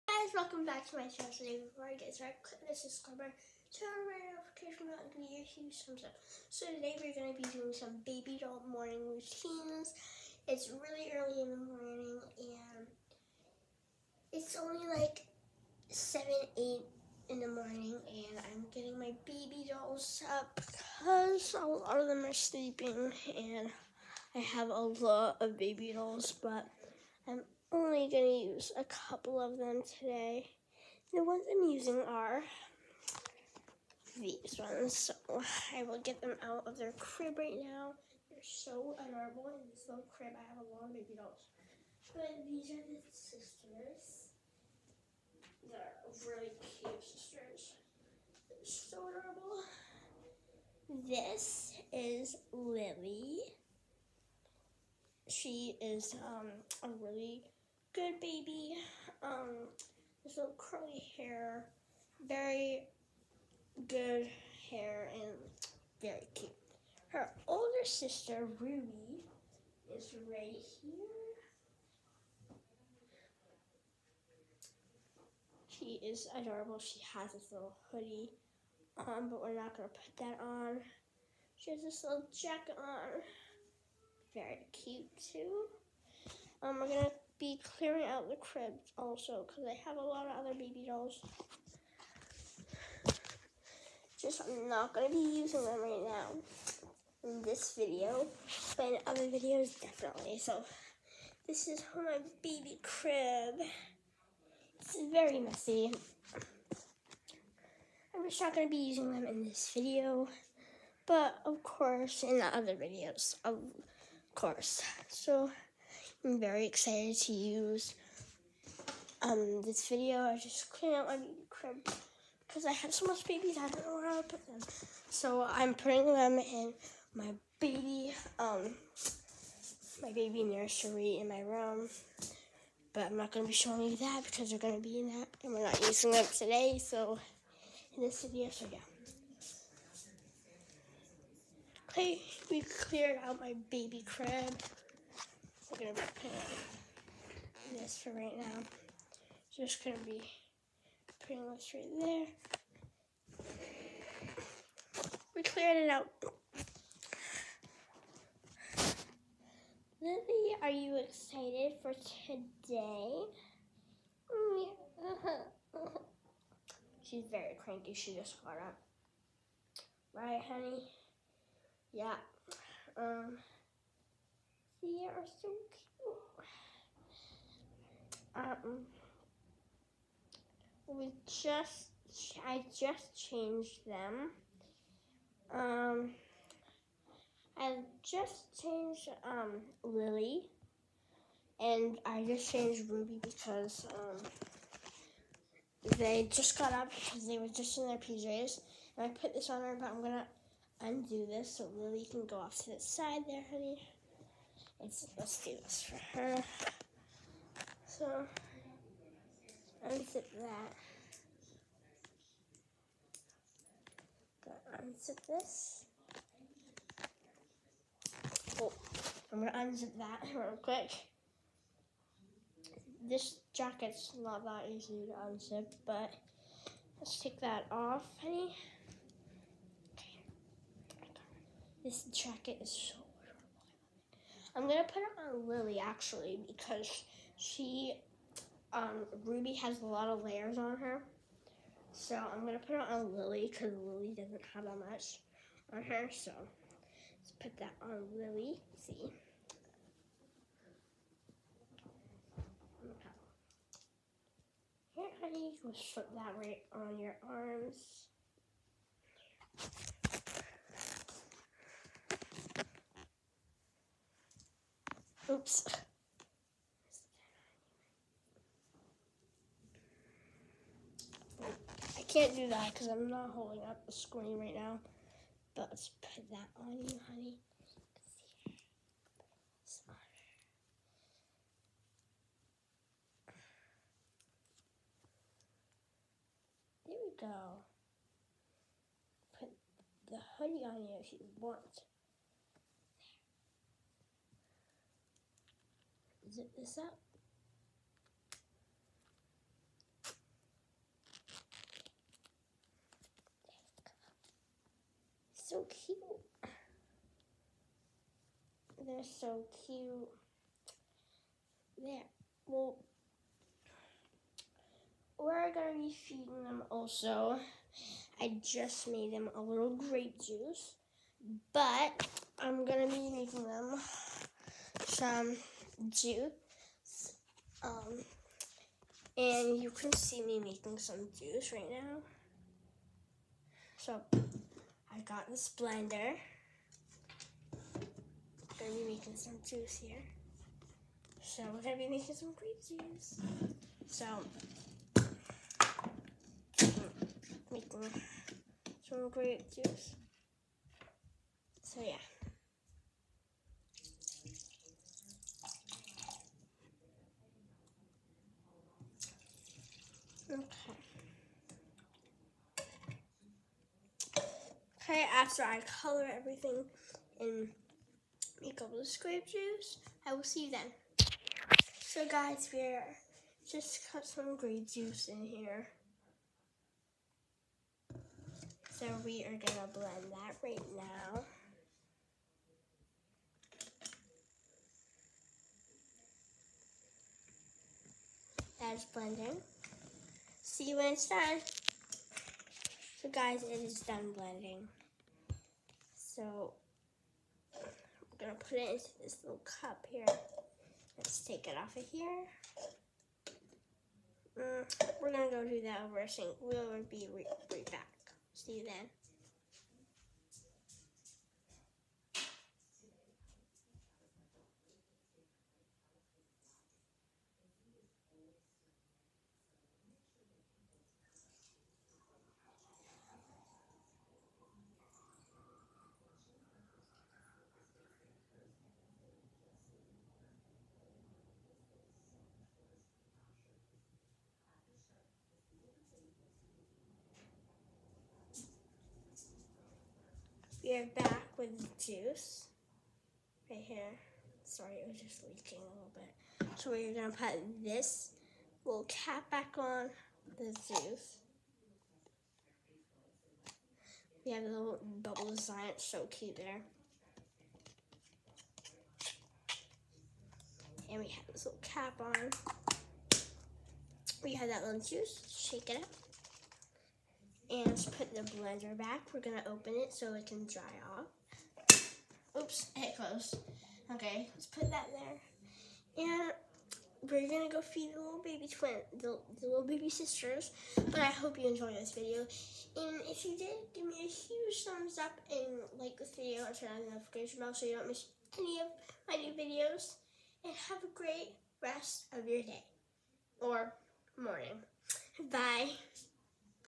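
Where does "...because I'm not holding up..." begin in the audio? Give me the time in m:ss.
4:32.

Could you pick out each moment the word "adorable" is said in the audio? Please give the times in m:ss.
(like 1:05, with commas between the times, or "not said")
0:38, 0:48, 1:16.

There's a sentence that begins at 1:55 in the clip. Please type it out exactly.
So I'm very excited to use um, this video.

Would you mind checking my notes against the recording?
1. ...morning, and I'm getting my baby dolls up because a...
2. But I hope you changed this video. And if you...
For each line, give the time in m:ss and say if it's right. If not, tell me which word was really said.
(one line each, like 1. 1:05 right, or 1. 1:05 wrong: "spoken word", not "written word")
1. 0:17 right
2. 8:00 wrong: "enjoyed", not "changed".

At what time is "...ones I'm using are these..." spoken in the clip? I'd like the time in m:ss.
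0:31.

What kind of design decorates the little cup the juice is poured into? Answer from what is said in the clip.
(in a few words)
bubble design.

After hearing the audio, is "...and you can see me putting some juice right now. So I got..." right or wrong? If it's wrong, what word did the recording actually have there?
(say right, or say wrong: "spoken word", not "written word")
wrong: "making", not "putting".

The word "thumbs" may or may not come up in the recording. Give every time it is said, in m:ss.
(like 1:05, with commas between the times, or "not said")
0:05, 8:04.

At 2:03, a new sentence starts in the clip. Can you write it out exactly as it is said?
I don't know where I put them.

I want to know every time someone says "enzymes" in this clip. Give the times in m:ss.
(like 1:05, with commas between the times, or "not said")
not said.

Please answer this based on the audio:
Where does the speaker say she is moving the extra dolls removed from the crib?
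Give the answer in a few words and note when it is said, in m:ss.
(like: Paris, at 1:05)
baby nursery, at 2:10.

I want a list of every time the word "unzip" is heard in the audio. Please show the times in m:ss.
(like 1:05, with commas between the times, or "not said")
3:29, 3:34, 3:39, 3:45.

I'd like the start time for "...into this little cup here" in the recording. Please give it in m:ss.
6:38.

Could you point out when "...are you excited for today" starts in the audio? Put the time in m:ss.
2:40.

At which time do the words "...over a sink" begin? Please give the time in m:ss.
6:45.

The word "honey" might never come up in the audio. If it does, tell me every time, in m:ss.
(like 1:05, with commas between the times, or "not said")
2:50, 3:23, 3:48, 4:15, 4:37, 4:50.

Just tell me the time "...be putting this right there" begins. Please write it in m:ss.
2:30.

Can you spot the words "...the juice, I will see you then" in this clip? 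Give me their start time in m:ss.
6:08.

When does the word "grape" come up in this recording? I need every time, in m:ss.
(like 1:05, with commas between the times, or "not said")
5:19, 5:42, 5:49, 6:14.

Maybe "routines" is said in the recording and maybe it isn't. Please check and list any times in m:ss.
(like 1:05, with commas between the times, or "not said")
0:09.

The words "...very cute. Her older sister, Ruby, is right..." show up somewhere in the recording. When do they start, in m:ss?
1:06.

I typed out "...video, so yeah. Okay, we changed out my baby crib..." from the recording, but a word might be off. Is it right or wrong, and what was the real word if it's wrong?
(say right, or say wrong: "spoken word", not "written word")
wrong: "cleared", not "changed".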